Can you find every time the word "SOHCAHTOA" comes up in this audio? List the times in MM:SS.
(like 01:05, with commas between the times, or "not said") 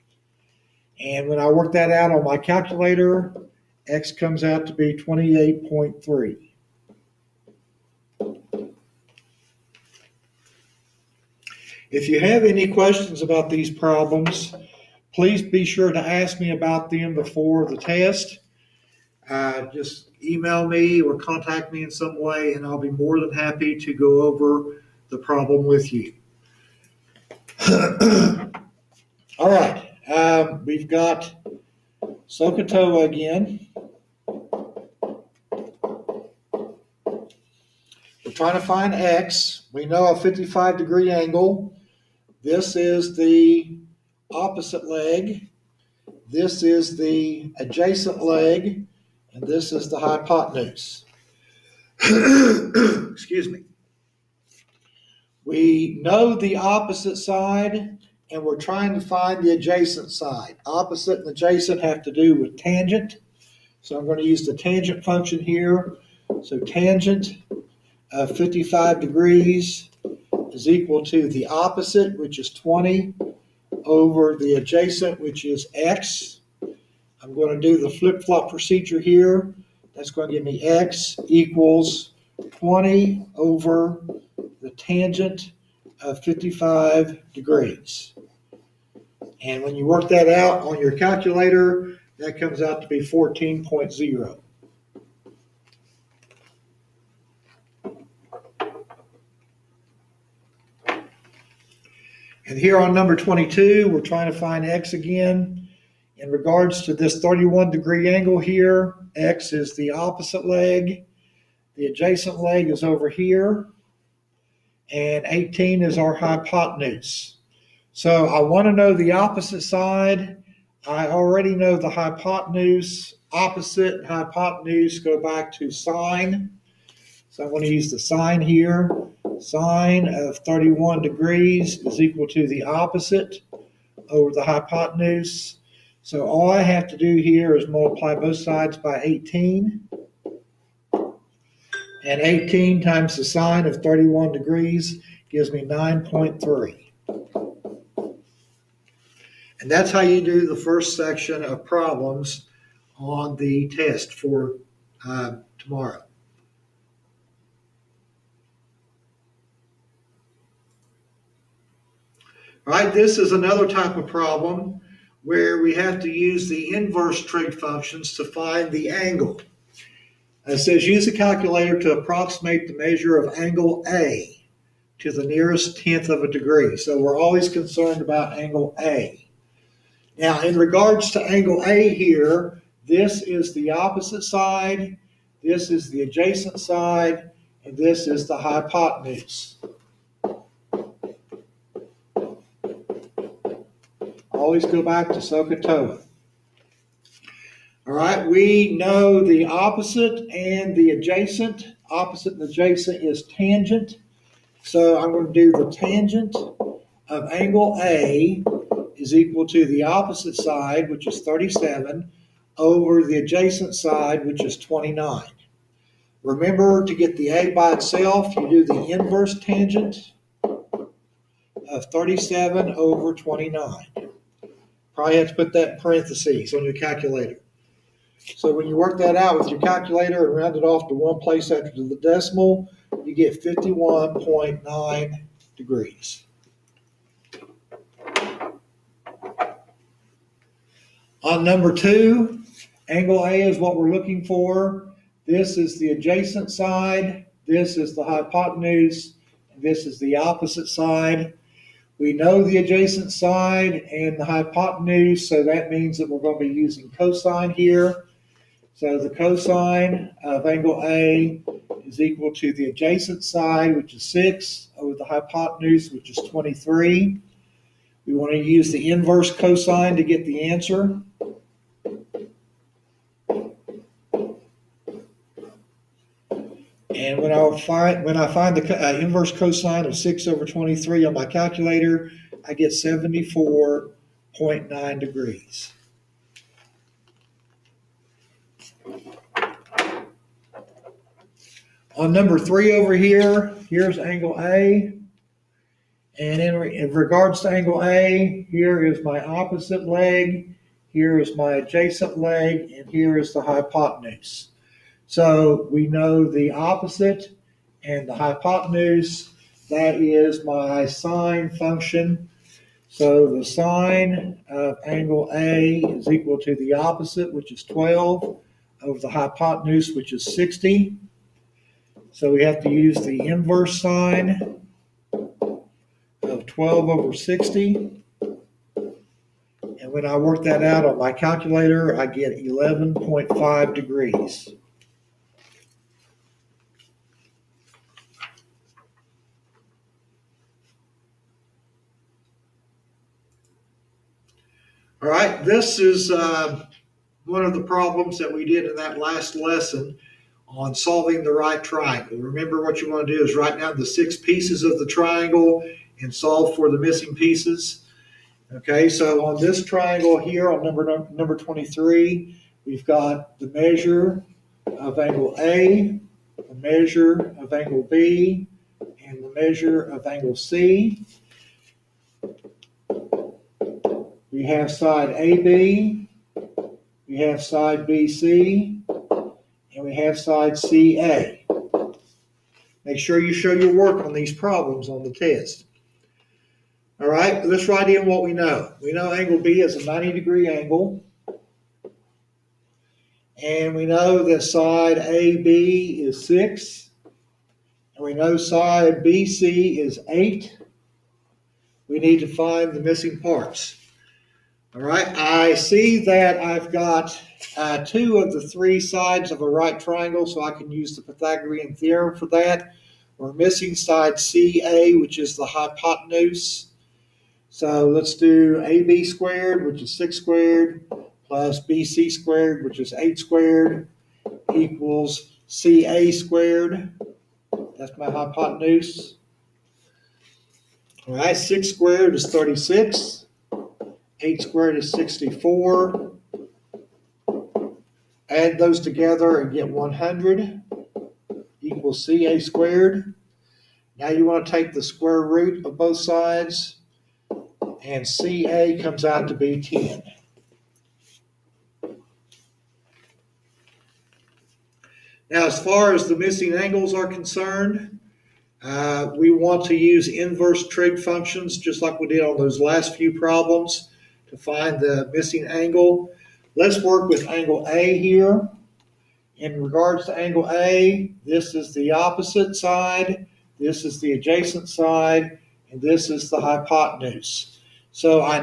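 00:32, 03:15.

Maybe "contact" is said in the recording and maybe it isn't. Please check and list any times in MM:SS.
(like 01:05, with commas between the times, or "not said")
00:21.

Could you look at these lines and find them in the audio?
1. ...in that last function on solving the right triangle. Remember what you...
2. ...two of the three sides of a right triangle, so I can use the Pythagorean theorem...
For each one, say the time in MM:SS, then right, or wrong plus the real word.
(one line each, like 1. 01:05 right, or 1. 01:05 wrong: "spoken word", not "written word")
1. 05:48 wrong: "lesson", not "function"
2. 06:47 right.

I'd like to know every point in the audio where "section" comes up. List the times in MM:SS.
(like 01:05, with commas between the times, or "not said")
02:30.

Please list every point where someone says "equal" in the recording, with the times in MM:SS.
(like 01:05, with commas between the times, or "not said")
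01:10, 01:21, 02:11, 03:29, 04:22, 05:16, 07:04, 07:21.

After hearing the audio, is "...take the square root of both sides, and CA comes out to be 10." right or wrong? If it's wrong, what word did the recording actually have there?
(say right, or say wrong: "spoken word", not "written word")
right.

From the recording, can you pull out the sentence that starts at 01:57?
So I want to know the opposite side.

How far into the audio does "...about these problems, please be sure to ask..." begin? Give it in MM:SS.
00:13.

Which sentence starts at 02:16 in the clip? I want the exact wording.
So all I have to do here is multiply both sides by 18.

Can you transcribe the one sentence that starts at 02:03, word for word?
Opposite and hypotenuse go back to sine.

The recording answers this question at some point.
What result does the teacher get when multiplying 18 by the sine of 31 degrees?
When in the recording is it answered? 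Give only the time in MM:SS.
02:25.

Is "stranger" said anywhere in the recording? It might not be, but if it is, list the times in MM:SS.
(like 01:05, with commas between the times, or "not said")
not said.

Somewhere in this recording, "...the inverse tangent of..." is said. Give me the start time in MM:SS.
03:38.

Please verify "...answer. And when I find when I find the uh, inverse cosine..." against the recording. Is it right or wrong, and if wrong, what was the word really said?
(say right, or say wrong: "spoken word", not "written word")
right.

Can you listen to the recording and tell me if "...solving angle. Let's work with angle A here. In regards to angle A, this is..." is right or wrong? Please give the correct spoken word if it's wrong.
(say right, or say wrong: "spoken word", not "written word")
wrong: "missing", not "solving".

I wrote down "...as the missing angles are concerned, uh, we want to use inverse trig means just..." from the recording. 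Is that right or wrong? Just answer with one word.
wrong.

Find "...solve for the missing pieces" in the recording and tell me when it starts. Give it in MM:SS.
05:56.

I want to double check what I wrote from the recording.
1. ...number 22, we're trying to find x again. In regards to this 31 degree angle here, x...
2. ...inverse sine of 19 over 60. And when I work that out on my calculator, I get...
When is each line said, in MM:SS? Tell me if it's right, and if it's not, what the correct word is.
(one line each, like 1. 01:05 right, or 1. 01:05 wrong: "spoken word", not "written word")
1. 01:42 right
2. 05:23 wrong: "12", not "19".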